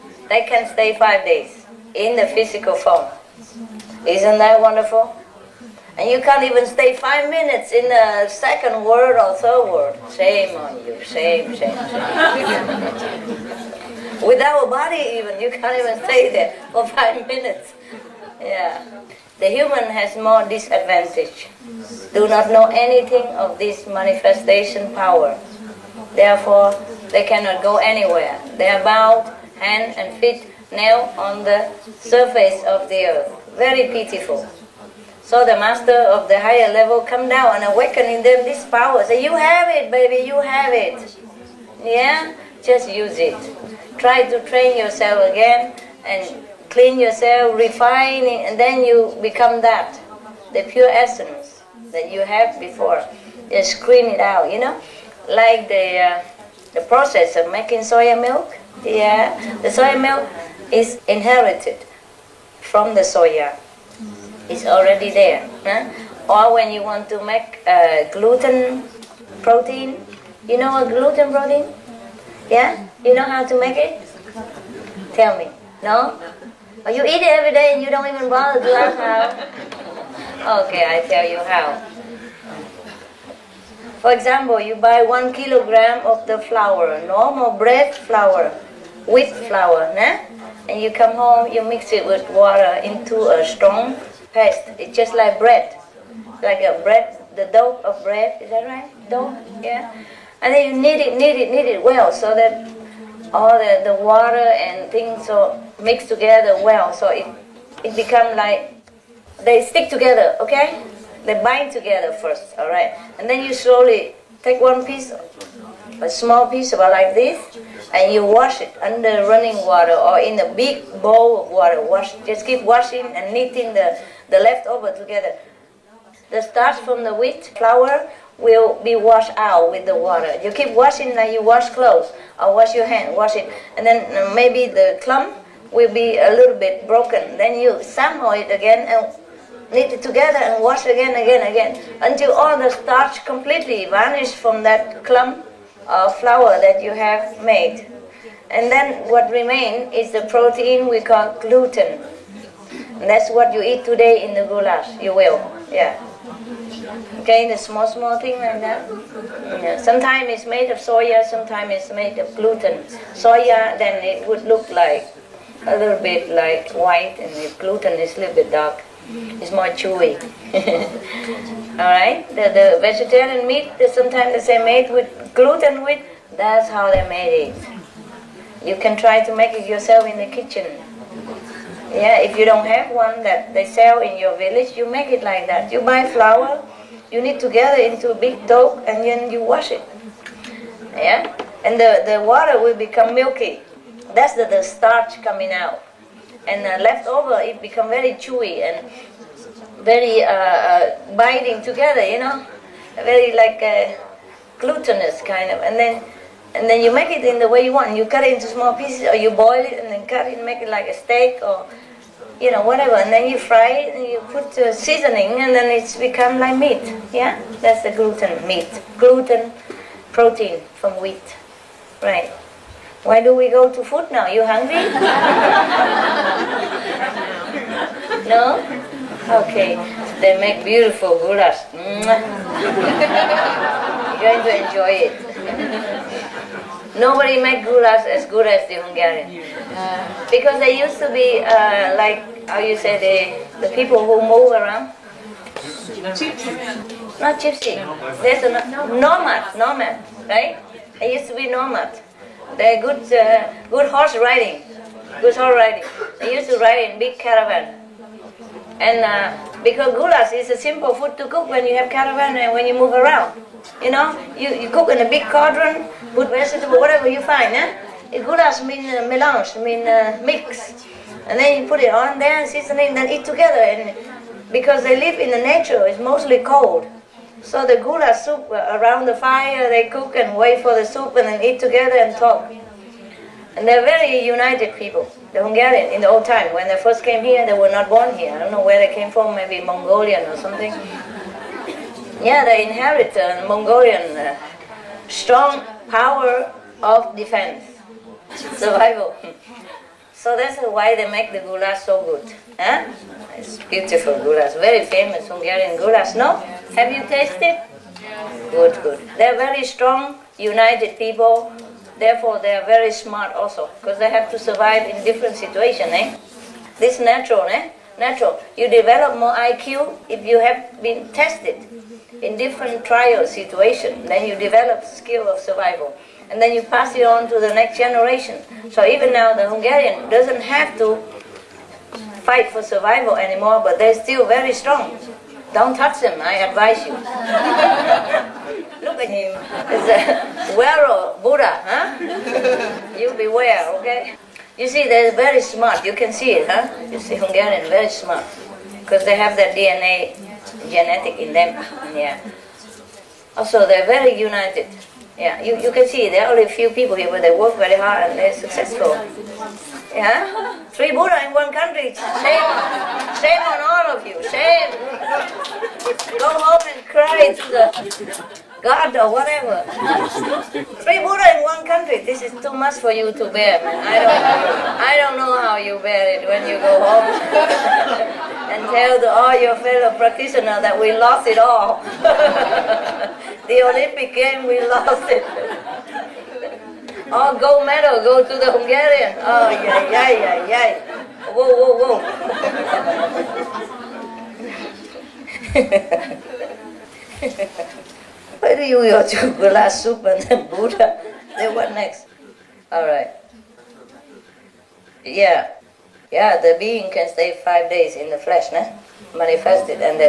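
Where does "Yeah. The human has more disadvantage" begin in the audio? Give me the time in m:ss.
0:18.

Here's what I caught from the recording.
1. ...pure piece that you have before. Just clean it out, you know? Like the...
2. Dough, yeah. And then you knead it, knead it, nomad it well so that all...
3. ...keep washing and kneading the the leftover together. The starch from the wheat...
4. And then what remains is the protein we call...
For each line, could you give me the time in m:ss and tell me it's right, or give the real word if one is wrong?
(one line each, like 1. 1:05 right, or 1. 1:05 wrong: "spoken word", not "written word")
1. 0:50 wrong: "essence", not "piece"
2. 1:39 wrong: "knead", not "nomad"
3. 2:02 right
4. 2:28 right.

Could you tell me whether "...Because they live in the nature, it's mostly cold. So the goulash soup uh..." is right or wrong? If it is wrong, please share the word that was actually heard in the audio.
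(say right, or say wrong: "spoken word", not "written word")
right.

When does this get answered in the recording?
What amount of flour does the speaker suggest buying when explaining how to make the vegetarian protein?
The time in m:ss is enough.
1:25.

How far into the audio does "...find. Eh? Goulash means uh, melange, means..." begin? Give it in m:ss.
4:27.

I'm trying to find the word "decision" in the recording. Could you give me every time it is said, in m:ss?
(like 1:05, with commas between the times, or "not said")
not said.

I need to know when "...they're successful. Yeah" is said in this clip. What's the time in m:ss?
5:58.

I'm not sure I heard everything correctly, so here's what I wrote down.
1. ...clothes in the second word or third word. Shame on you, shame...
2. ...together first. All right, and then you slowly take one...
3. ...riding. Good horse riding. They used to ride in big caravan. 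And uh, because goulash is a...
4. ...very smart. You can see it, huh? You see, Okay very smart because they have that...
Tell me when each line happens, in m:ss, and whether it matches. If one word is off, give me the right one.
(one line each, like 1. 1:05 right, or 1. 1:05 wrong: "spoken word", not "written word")
1. 0:07 wrong: "minutes", not "clothes"
2. 1:51 right
3. 4:14 right
4. 5:45 wrong: "Hungarian", not "Okay".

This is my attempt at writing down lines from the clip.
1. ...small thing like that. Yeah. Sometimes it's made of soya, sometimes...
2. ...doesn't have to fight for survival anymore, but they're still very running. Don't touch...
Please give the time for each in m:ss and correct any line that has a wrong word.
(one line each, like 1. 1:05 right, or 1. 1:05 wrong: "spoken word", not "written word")
1. 2:37 right
2. 5:30 wrong: "strong", not "running".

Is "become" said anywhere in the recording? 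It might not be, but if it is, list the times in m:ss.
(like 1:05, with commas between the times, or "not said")
0:49, 1:47, 3:12, 3:17, 3:35.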